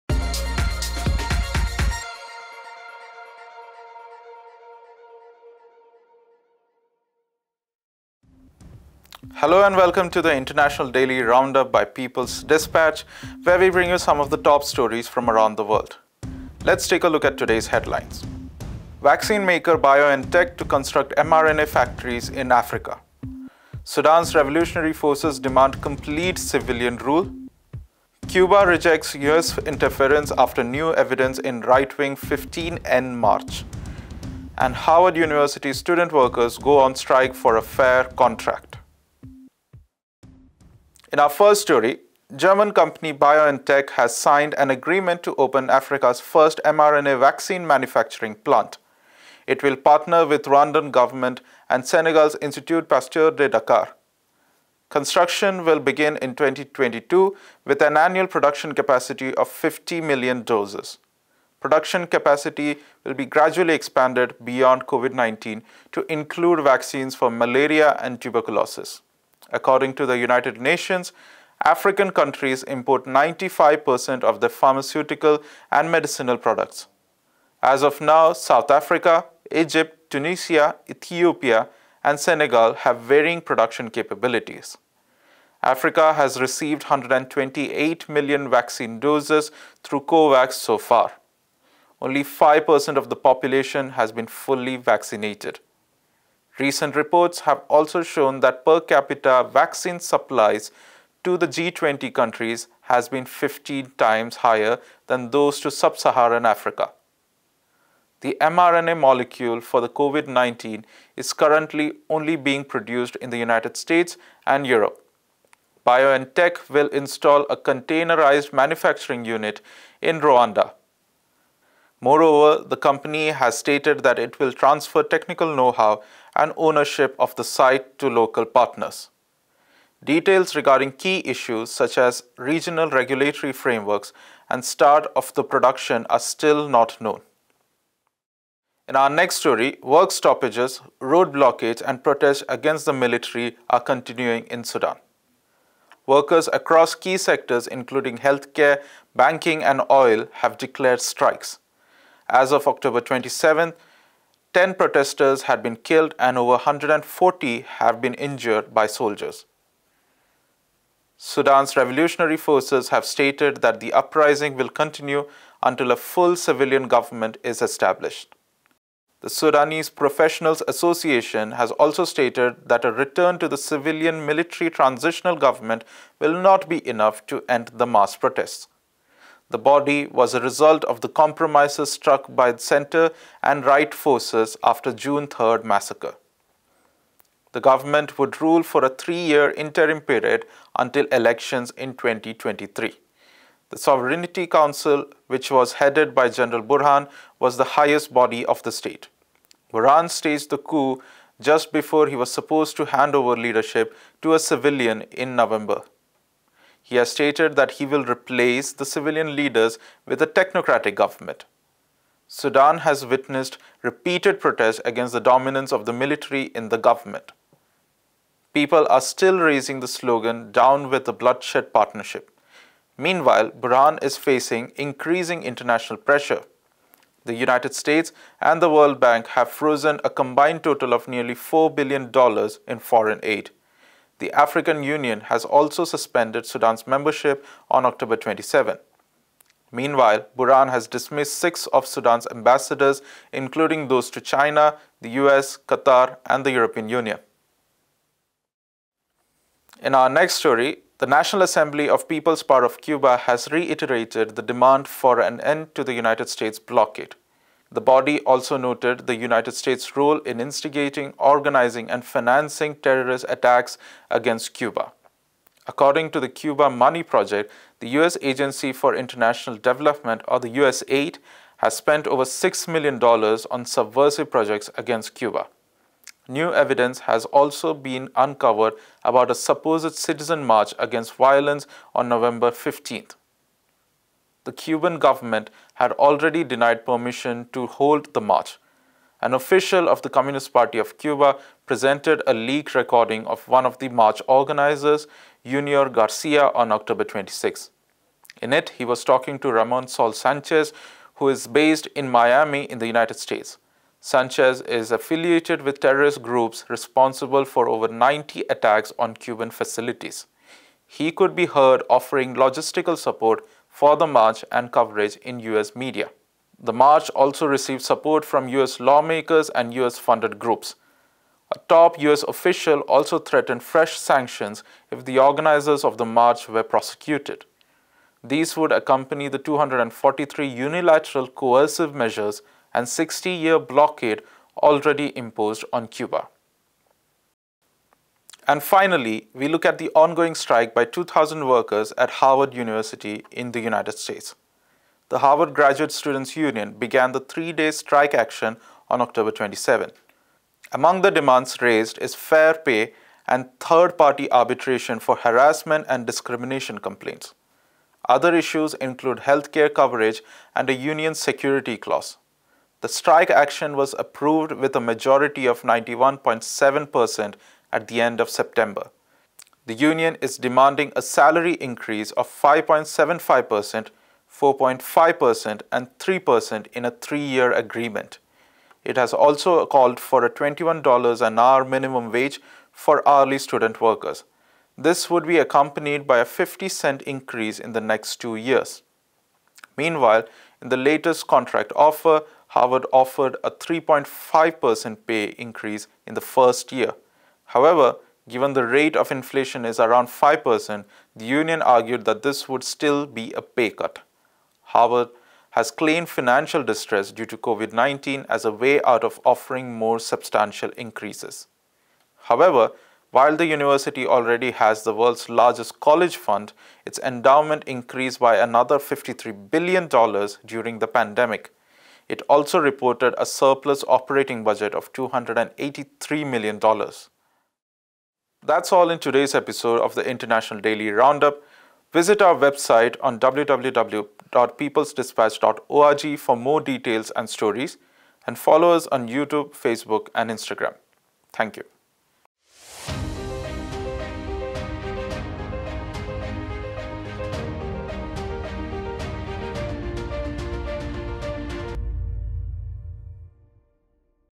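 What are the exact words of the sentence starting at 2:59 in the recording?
The body was a result of the compromises struck by the center and right forces after June 3rd massacre.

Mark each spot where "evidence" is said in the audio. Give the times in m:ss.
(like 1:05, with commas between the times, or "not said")
0:30, 4:36.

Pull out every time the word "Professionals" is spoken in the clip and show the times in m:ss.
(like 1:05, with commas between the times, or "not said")
2:49.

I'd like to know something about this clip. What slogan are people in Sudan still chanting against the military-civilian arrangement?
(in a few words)
Down with the Bloodshed Partnership.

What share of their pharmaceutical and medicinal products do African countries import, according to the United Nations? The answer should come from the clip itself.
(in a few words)
95%.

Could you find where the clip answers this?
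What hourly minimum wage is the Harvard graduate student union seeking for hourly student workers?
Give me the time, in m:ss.
6:20.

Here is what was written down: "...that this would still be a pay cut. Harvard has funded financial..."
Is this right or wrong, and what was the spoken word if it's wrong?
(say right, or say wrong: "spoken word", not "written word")
wrong: "claimed", not "funded".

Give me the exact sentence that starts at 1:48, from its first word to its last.
The mRNA molecule for the COVID 19 is currently only being produced in the United States and Europe.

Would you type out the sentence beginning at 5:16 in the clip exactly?
The march also received support from US lawmakers and US funded groups.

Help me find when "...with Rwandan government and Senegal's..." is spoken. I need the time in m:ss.
0:50.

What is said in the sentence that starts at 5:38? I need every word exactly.
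And finally, we look at the ongoing strike by 2,000 workers at Harvard University in the United States.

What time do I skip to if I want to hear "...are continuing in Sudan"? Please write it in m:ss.
2:23.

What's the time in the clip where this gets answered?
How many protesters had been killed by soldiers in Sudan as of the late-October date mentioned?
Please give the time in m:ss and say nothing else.
2:34.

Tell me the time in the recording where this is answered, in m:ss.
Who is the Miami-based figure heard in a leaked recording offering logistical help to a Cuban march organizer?
4:59.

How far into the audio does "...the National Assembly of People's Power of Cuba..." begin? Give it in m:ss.
4:10.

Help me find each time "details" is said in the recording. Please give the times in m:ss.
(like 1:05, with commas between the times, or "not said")
2:10, 7:16.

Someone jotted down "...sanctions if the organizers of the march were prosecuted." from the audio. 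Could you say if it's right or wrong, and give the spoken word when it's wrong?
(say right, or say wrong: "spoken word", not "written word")
right.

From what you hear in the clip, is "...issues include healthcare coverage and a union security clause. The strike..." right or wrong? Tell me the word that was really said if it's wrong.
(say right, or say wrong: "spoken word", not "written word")
right.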